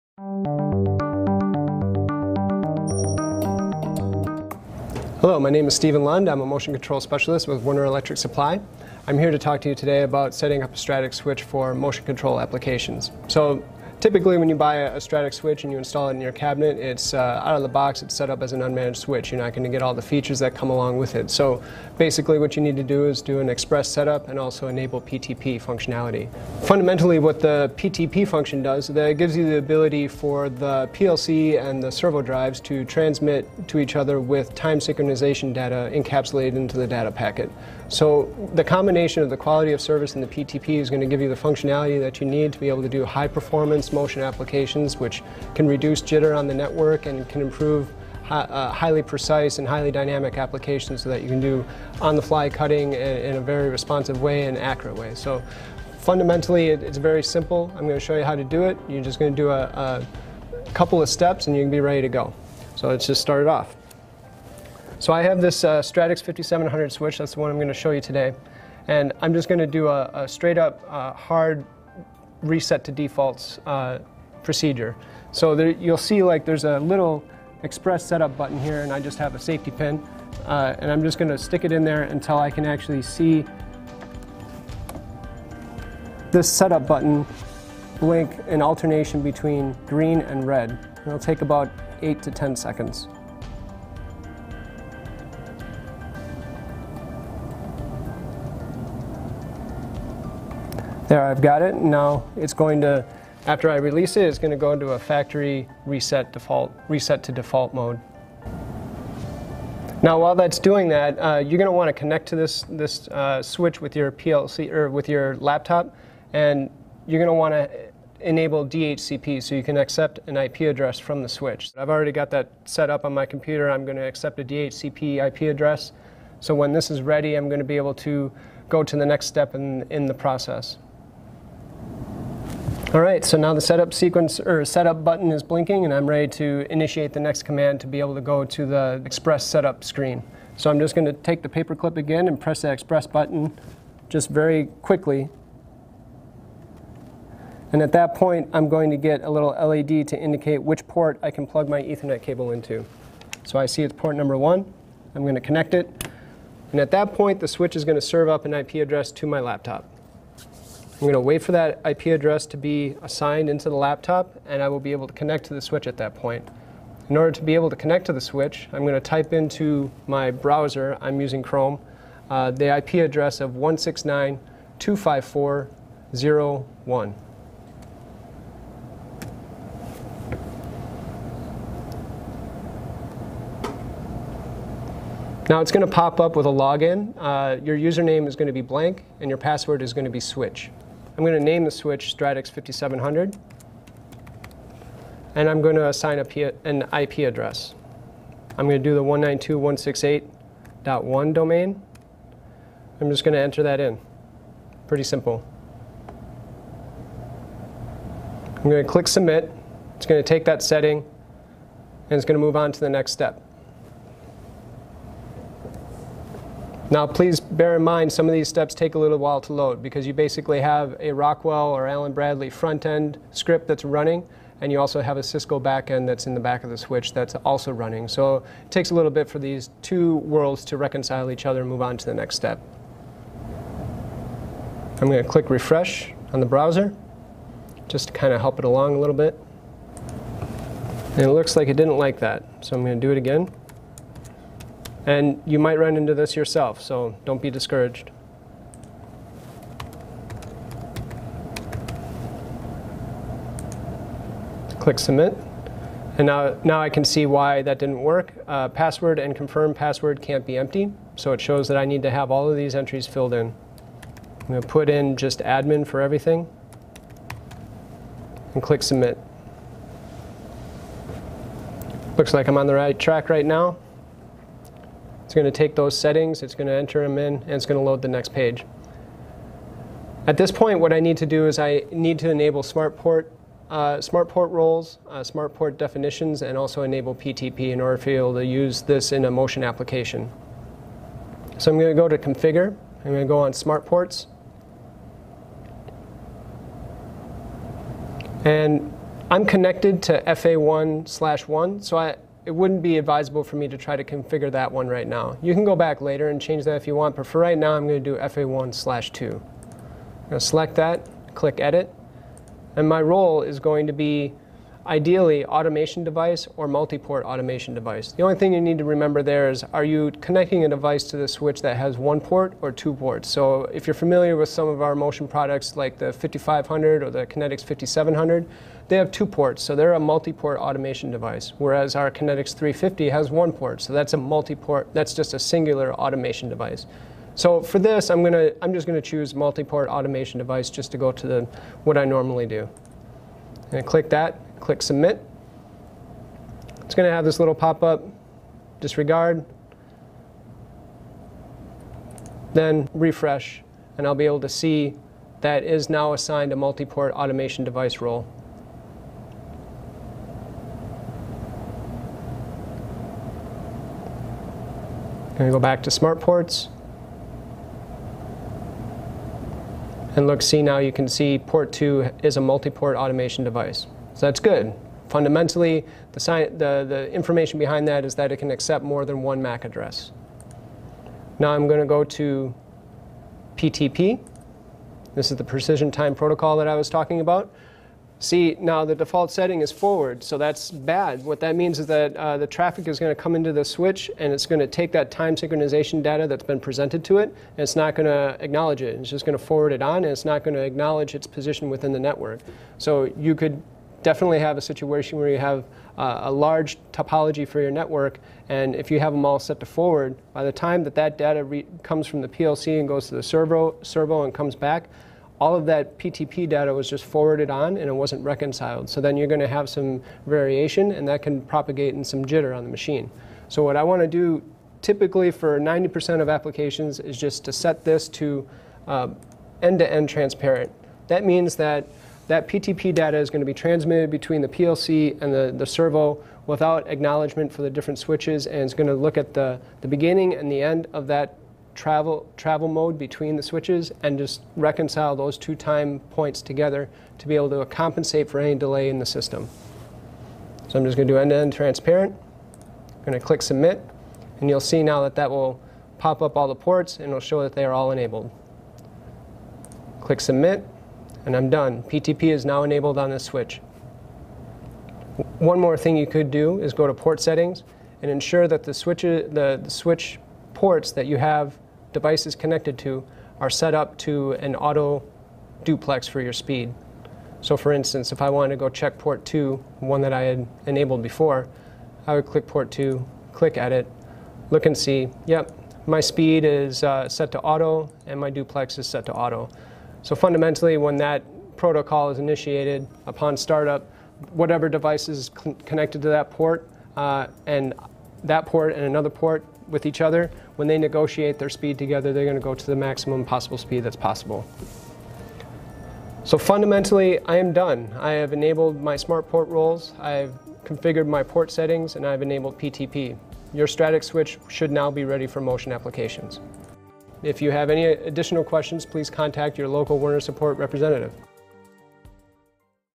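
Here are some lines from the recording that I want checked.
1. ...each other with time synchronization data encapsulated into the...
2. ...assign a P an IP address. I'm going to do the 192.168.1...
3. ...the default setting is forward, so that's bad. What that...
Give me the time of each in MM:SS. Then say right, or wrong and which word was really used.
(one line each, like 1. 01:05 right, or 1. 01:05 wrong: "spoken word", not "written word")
1. 00:33 right
2. 03:15 right
3. 06:28 right.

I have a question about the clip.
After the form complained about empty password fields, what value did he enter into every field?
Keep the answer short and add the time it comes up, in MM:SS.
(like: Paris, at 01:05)
admin, at 04:25.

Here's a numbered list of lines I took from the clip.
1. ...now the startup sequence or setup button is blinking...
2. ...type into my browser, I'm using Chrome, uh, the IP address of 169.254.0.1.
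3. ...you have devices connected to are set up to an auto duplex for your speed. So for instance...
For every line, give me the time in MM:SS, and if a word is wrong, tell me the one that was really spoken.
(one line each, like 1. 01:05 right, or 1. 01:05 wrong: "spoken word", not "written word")
1. 02:13 wrong: "setup", not "startup"
2. 02:48 right
3. 07:51 right.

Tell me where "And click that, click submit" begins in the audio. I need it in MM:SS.
05:43.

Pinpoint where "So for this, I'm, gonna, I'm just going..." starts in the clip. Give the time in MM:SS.
05:37.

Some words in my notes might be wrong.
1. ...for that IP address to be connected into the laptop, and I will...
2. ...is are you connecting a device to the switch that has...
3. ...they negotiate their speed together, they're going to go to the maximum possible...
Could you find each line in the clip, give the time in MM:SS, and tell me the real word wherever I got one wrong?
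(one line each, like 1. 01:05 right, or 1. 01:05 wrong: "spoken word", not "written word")
1. 02:41 wrong: "assigned", not "connected"
2. 05:19 right
3. 08:20 right.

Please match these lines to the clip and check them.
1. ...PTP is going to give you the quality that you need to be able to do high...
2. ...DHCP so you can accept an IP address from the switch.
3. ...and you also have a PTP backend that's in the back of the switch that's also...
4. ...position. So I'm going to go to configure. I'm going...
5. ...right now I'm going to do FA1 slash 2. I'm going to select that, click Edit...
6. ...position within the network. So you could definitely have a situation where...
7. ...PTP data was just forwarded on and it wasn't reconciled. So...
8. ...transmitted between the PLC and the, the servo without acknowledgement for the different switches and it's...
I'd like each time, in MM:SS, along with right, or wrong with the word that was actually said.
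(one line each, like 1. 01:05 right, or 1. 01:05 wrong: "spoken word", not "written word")
1. 00:40 wrong: "functionality", not "quality"
2. 01:58 right
3. 03:44 wrong: "Cisco", not "PTP"
4. 04:49 wrong: "application", not "position"
5. 05:07 right
6. 06:41 right
7. 06:55 right
8. 07:13 right.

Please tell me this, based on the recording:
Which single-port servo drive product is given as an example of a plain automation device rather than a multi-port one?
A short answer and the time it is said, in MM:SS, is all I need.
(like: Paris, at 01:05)
Kinetix 350, at 05:32.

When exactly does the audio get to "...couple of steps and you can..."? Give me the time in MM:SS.
01:00.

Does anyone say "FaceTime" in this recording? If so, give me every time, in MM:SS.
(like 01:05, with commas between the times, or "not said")
not said.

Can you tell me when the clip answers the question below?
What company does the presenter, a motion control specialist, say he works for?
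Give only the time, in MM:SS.
00:07.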